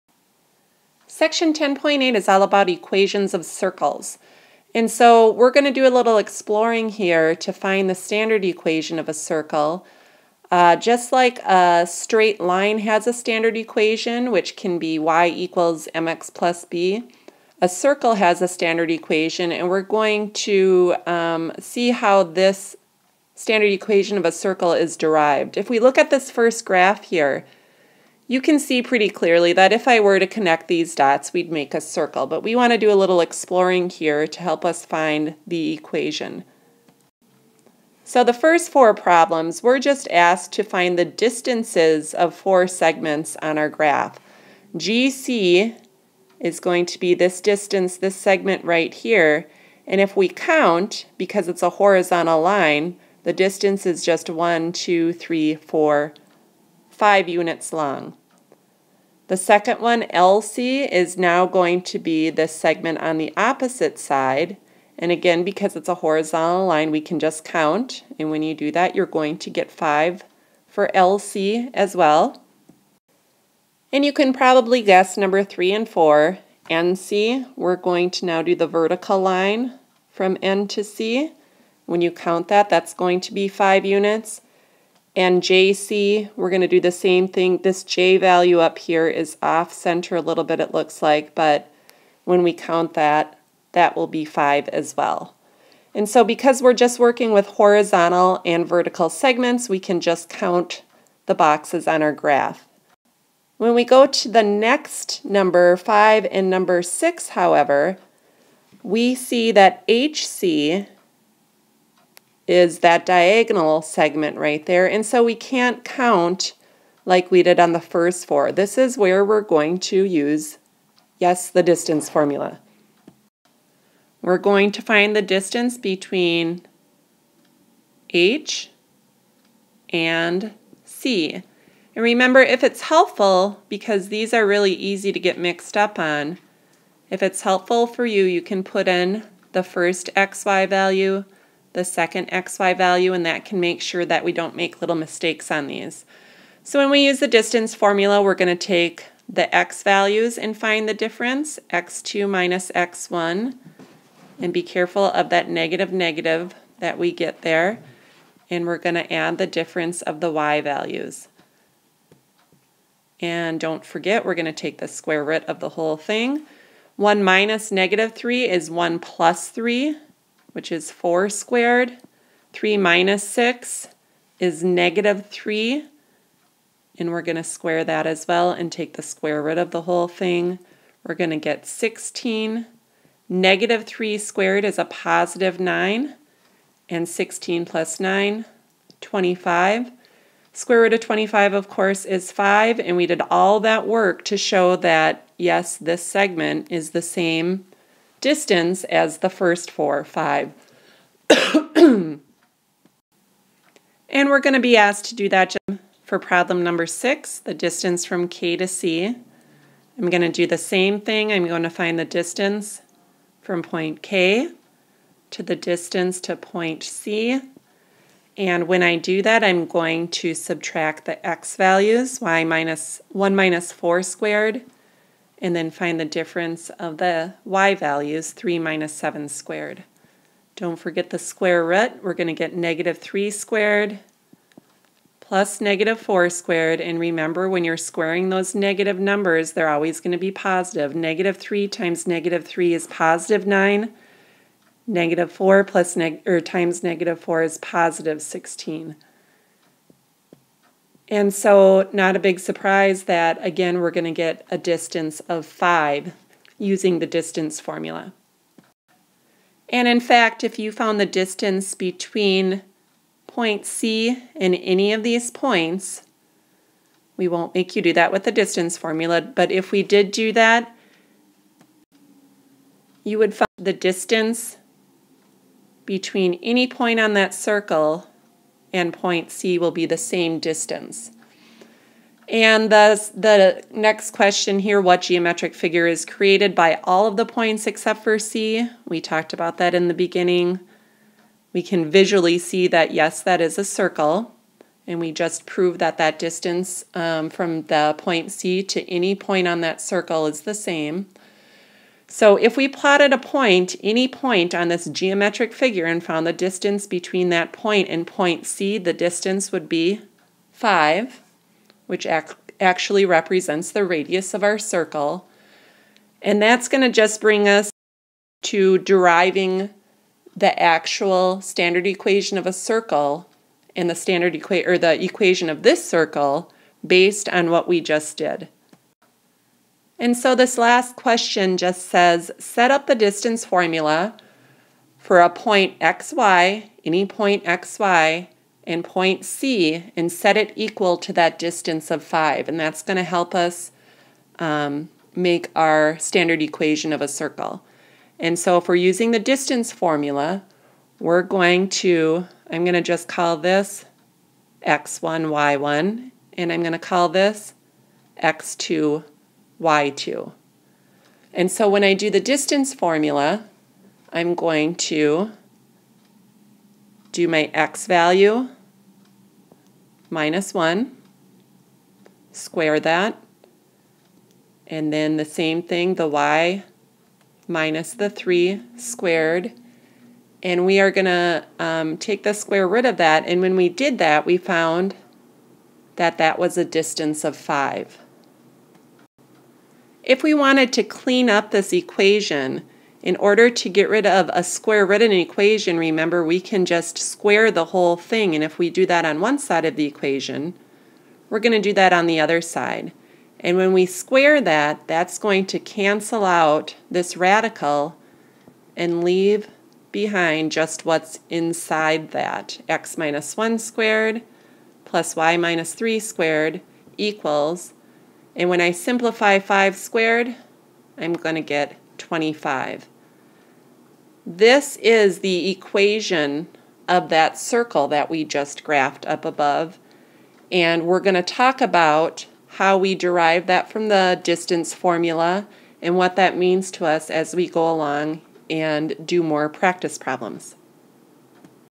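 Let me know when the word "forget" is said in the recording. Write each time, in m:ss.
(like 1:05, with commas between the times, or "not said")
2:43, 3:50.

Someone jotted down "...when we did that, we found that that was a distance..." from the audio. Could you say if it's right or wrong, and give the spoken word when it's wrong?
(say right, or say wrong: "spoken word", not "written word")
right.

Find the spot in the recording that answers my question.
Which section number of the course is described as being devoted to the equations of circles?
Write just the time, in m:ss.
0:01.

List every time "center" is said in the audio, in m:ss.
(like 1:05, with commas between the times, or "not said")
1:29.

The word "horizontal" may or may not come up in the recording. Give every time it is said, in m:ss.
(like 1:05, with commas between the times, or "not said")
0:51, 1:06, 1:37.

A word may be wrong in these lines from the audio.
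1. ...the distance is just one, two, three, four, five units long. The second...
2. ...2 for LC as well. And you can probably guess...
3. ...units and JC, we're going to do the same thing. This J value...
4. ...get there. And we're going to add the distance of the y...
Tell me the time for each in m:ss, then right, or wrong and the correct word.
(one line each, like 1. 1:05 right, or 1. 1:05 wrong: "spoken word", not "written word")
1. 0:53 right
2. 1:09 wrong: "5", not "2"
3. 1:23 right
4. 2:37 wrong: "difference", not "distance".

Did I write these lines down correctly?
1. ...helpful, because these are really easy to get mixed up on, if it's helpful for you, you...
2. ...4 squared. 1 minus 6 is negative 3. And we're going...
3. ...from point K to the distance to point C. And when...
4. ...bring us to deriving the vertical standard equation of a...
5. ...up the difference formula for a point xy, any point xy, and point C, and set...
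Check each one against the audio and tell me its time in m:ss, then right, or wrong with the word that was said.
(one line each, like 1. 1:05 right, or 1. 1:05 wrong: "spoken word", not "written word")
1. 2:12 right
2. 2:50 wrong: "3", not "1"
3. 3:33 right
4. 5:17 wrong: "actual", not "vertical"
5. 5:32 wrong: "distance", not "difference".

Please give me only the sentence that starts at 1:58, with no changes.
This is where we're going to use, yes, the distance formula.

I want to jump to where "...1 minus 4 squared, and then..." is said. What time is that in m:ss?
3:43.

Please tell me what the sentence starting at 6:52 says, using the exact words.
x minus 1 squared plus y minus 3 squared equals and when I simplify 5 squared, I'm going to get 25.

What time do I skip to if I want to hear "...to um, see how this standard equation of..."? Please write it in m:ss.
0:20.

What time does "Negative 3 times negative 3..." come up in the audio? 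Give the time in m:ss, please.
4:00.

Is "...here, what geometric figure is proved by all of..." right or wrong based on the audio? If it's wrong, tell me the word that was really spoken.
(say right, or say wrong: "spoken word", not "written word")
wrong: "created", not "proved".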